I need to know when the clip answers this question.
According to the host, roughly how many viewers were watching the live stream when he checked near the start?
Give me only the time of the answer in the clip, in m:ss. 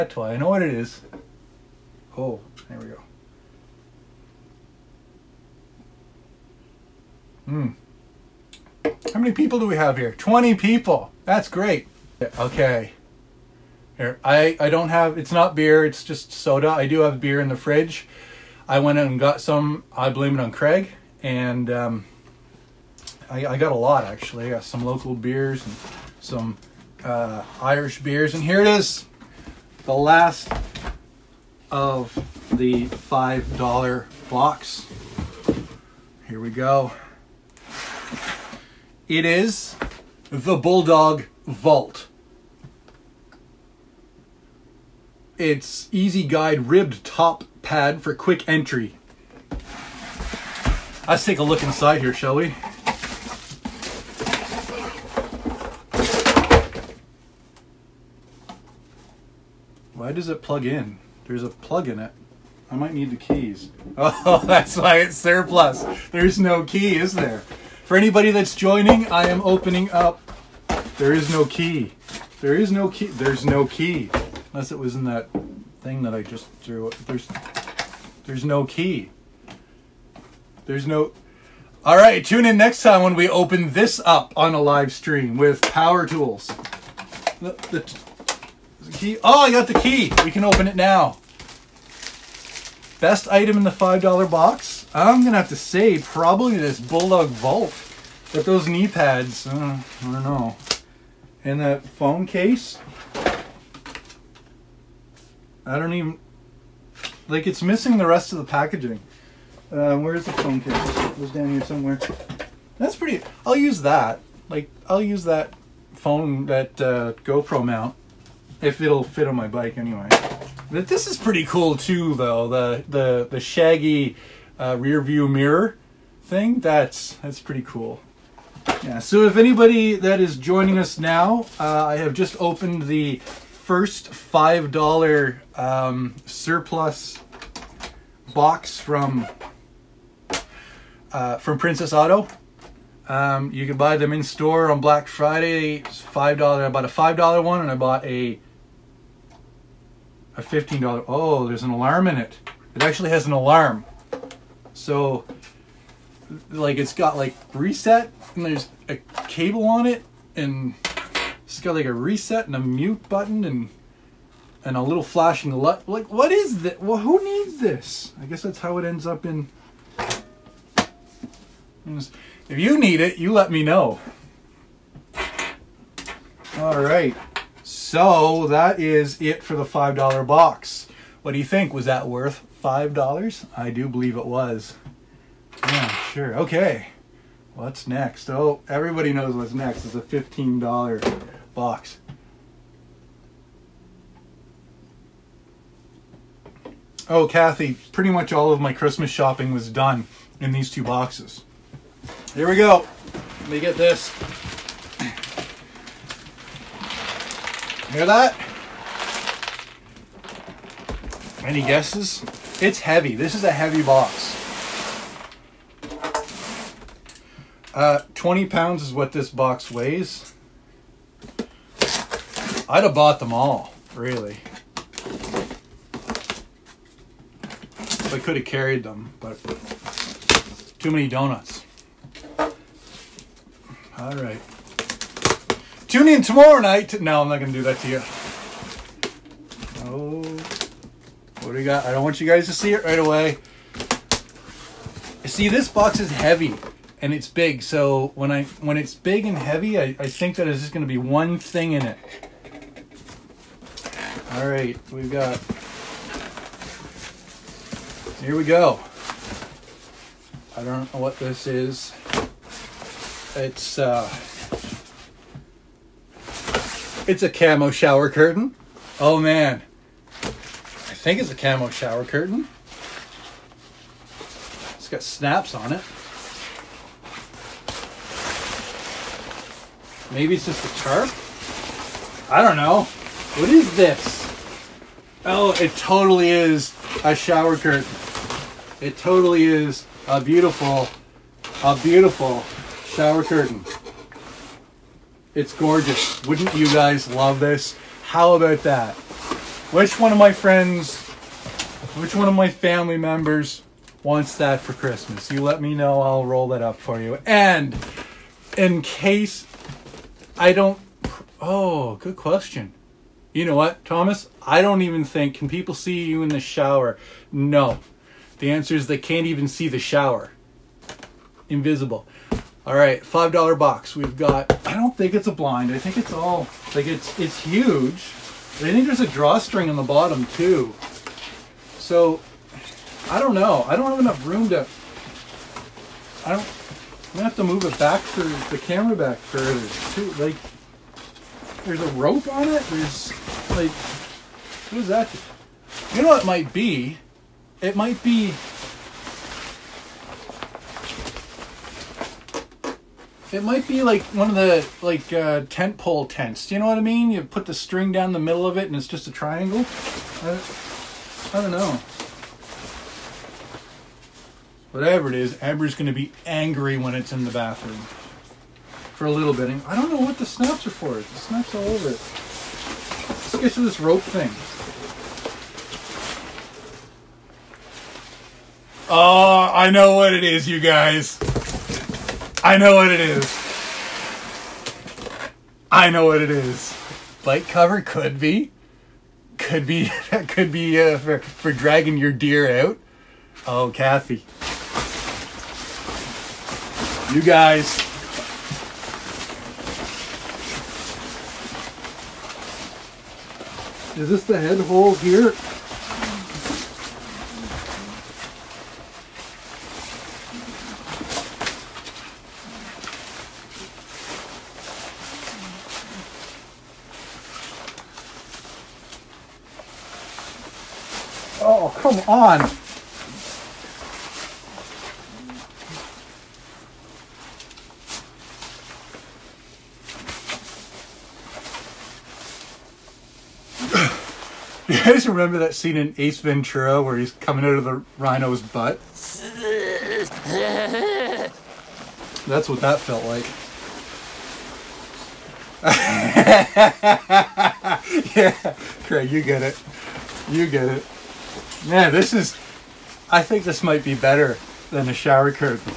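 0:10.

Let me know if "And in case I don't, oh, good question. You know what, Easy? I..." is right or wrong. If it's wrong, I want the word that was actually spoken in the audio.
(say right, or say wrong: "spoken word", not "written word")
wrong: "Thomas", not "Easy".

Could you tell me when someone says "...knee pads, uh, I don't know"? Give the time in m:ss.
1:38.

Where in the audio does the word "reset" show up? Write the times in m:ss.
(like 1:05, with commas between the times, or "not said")
2:37, 2:41.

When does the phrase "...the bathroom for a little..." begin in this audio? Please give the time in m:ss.
6:07.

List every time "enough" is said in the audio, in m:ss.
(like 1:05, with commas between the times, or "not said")
5:34.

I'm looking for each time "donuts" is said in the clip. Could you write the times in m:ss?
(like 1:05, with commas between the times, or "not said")
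3:51.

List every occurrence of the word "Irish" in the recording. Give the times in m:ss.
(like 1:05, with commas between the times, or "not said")
0:27.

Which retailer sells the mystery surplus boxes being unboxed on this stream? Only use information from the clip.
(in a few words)
Princess Auto.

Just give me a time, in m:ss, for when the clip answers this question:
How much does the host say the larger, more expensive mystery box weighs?
3:38.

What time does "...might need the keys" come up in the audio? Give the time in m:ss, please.
1:02.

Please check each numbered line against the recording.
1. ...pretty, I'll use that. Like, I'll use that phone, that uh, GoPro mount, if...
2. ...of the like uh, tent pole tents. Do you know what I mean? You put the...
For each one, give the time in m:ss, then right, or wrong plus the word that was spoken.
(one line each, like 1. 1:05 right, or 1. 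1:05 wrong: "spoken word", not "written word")
1. 1:52 right
2. 5:54 right.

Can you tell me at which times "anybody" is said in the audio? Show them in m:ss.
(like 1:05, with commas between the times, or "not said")
1:07, 2:09.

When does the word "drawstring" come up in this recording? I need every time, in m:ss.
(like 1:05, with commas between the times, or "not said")
5:29.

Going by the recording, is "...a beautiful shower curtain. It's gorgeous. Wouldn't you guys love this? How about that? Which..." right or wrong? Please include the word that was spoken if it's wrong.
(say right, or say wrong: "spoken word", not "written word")
right.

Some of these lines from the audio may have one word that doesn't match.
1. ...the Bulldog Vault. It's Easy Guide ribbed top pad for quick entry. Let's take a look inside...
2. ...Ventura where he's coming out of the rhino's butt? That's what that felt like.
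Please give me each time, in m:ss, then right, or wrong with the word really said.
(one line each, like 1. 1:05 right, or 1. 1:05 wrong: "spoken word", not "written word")
1. 0:40 right
2. 7:16 right.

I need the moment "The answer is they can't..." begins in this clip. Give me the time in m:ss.
5:18.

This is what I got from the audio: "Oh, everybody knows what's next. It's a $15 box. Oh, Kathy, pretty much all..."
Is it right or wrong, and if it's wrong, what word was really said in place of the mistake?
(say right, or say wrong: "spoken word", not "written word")
right.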